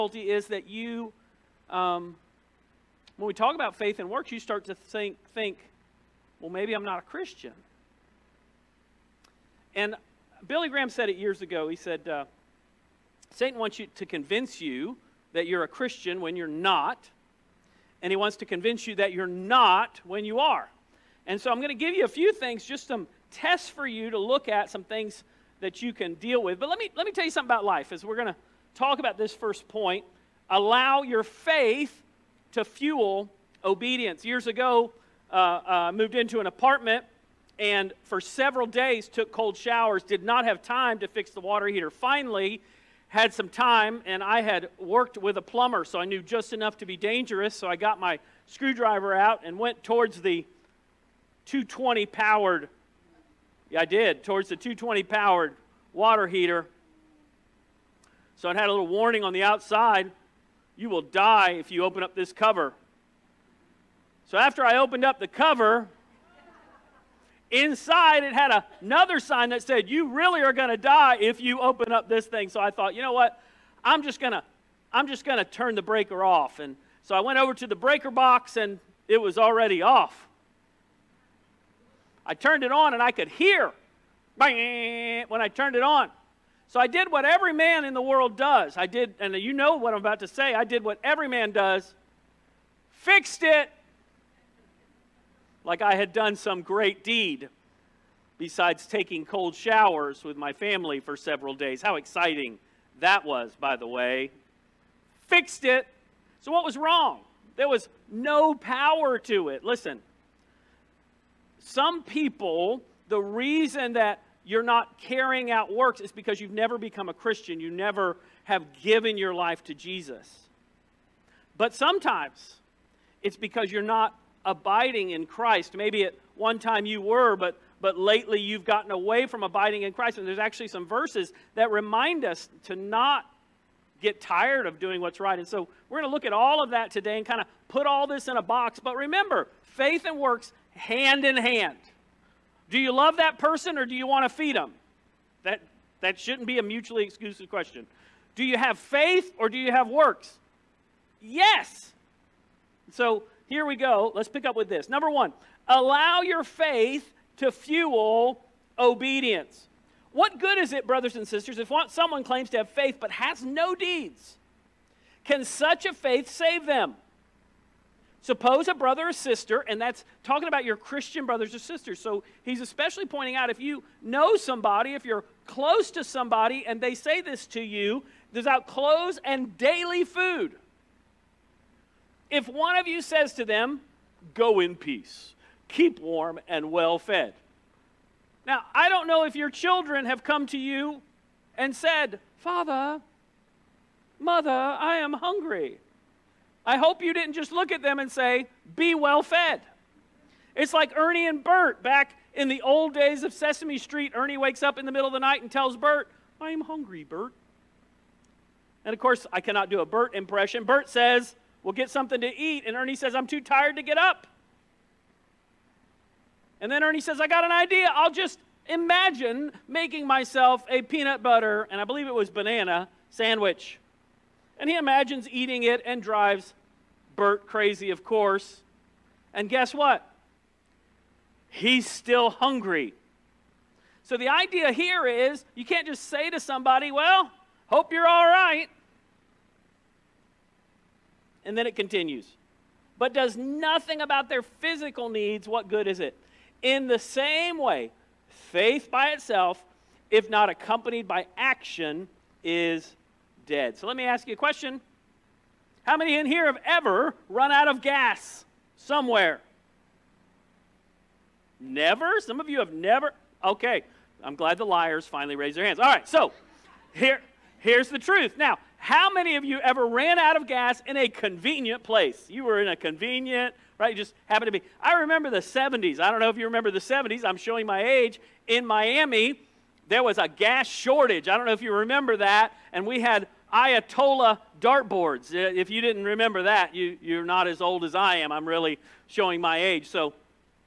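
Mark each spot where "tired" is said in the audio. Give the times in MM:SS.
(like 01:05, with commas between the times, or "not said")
02:14, 03:33.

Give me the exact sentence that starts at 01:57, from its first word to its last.
You never have given your life to Jesus.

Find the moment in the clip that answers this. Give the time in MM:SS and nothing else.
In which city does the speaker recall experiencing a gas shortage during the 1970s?
04:38.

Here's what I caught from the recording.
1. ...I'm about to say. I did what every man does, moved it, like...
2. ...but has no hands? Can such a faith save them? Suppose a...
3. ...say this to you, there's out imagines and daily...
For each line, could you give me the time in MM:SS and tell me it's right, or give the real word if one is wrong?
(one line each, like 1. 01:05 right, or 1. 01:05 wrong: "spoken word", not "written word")
1. 01:29 wrong: "fixed", not "moved"
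2. 02:42 wrong: "deeds", not "hands"
3. 02:56 wrong: "clothes", not "imagines".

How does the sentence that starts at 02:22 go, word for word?
Do you love that person or do you want to feed them?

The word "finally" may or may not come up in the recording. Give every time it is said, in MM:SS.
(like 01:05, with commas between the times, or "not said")
00:41, 04:25.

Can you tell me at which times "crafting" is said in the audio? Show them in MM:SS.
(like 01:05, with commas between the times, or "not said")
not said.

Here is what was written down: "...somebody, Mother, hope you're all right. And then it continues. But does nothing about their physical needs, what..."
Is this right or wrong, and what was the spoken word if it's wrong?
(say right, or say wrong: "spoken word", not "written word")
wrong: "Well", not "Mother".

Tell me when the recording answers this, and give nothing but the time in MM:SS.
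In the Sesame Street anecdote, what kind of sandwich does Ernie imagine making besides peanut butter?
03:42.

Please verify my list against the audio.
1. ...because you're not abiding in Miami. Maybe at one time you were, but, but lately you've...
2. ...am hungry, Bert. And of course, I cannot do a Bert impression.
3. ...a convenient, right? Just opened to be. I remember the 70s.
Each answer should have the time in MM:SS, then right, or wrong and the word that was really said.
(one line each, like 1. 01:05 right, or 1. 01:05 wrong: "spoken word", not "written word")
1. 02:03 wrong: "Christ", not "Miami"
2. 03:26 right
3. 04:32 wrong: "happened", not "opened".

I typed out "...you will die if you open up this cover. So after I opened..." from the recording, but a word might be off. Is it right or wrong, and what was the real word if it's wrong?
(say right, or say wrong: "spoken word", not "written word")
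right.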